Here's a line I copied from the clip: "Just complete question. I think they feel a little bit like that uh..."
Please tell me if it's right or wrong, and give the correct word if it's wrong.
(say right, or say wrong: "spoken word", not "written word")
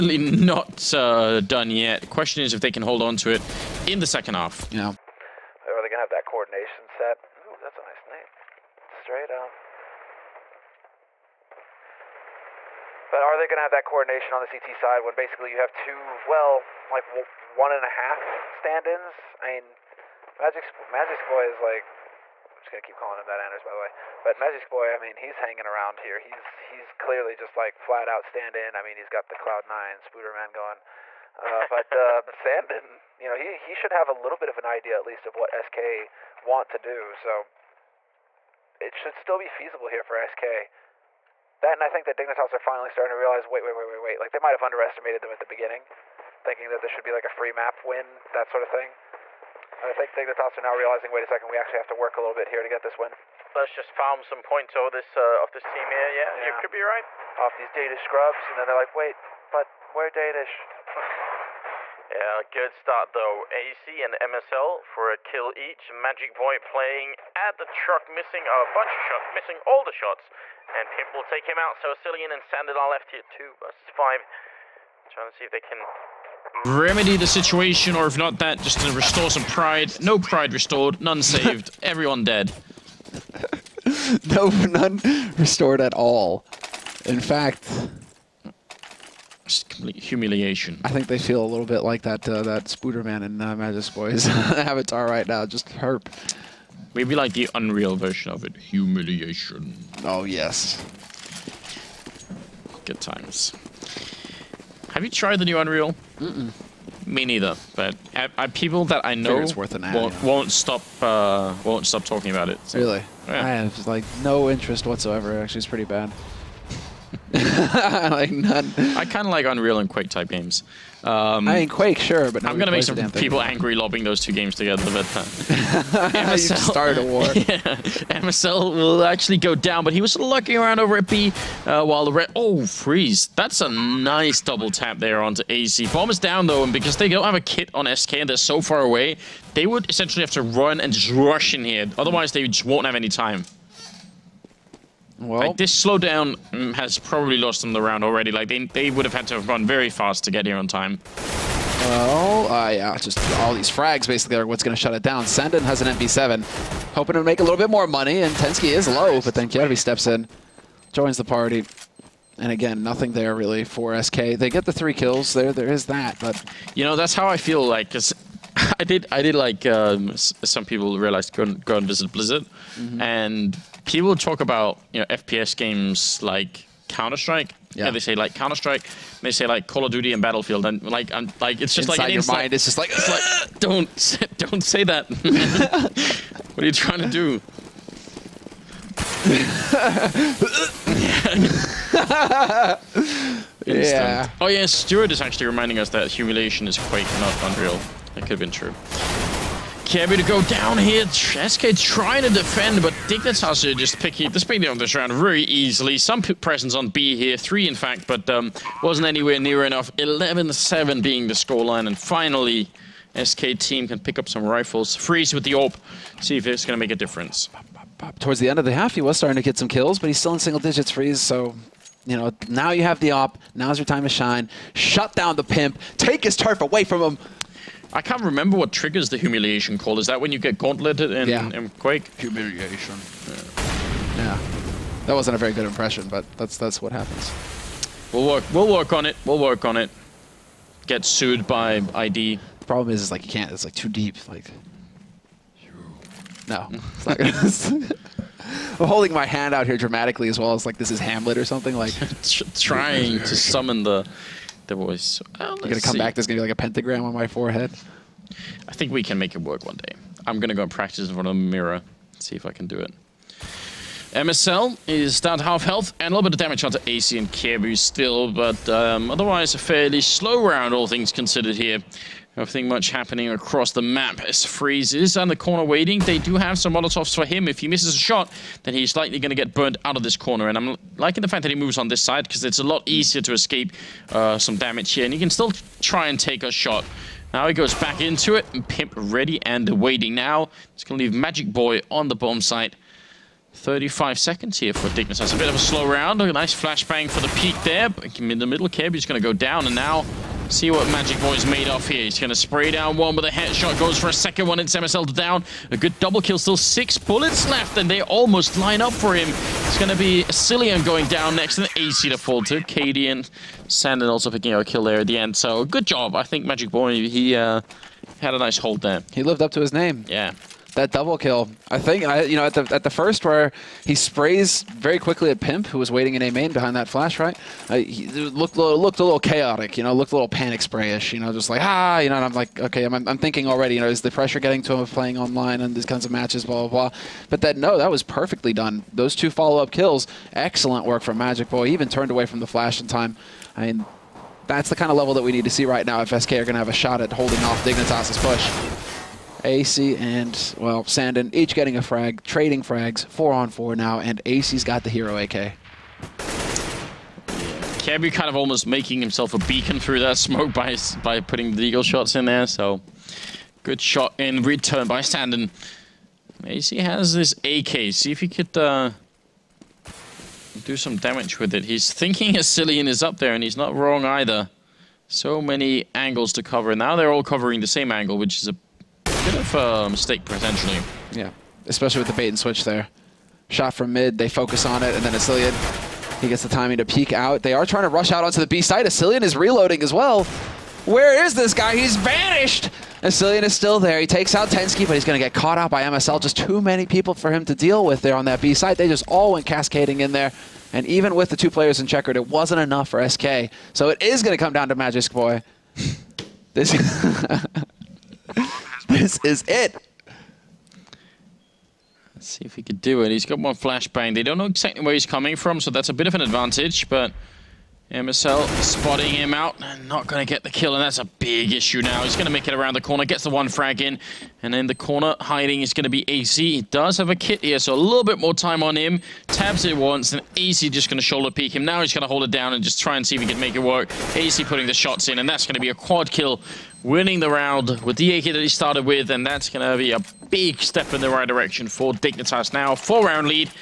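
wrong: "humiliation", not "question".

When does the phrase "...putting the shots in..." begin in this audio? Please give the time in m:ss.
7:14.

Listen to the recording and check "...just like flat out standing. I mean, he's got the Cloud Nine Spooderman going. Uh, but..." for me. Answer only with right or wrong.
right.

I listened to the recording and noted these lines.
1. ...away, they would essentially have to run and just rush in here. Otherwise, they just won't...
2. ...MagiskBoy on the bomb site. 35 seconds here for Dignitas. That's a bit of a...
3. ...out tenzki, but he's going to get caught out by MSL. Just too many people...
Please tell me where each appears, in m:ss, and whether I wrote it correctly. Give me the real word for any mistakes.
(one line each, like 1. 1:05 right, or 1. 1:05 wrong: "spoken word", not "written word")
1. 2:18 right
2. 4:51 right
3. 6:34 right.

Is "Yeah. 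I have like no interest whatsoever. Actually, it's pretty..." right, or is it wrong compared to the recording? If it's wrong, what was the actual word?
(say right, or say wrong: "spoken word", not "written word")
right.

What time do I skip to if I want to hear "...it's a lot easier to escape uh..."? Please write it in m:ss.
4:42.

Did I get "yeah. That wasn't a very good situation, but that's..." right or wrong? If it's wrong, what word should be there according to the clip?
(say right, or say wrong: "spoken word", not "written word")
wrong: "impression", not "situation".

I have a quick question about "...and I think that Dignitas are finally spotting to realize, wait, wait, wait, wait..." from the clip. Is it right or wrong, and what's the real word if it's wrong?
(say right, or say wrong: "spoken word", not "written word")
wrong: "starting", not "spotting".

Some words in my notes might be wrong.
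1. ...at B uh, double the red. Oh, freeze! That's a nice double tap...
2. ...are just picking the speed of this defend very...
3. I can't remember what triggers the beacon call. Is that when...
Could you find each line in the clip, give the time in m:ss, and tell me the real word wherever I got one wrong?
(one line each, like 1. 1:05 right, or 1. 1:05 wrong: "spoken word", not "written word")
1. 2:10 wrong: "while", not "double"
2. 3:23 wrong: "round", not "defend"
3. 3:47 wrong: "humiliation", not "beacon".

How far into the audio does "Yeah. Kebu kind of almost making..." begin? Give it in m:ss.
5:55.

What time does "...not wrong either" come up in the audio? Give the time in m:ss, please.
6:13.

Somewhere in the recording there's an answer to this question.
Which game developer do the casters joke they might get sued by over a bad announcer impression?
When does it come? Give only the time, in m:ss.
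4:01.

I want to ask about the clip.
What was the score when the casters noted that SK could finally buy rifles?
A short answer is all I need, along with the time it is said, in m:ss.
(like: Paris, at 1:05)
11-7, at 3:29.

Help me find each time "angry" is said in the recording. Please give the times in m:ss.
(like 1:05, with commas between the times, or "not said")
2:03.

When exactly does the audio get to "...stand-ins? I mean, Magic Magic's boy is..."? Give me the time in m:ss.
0:18.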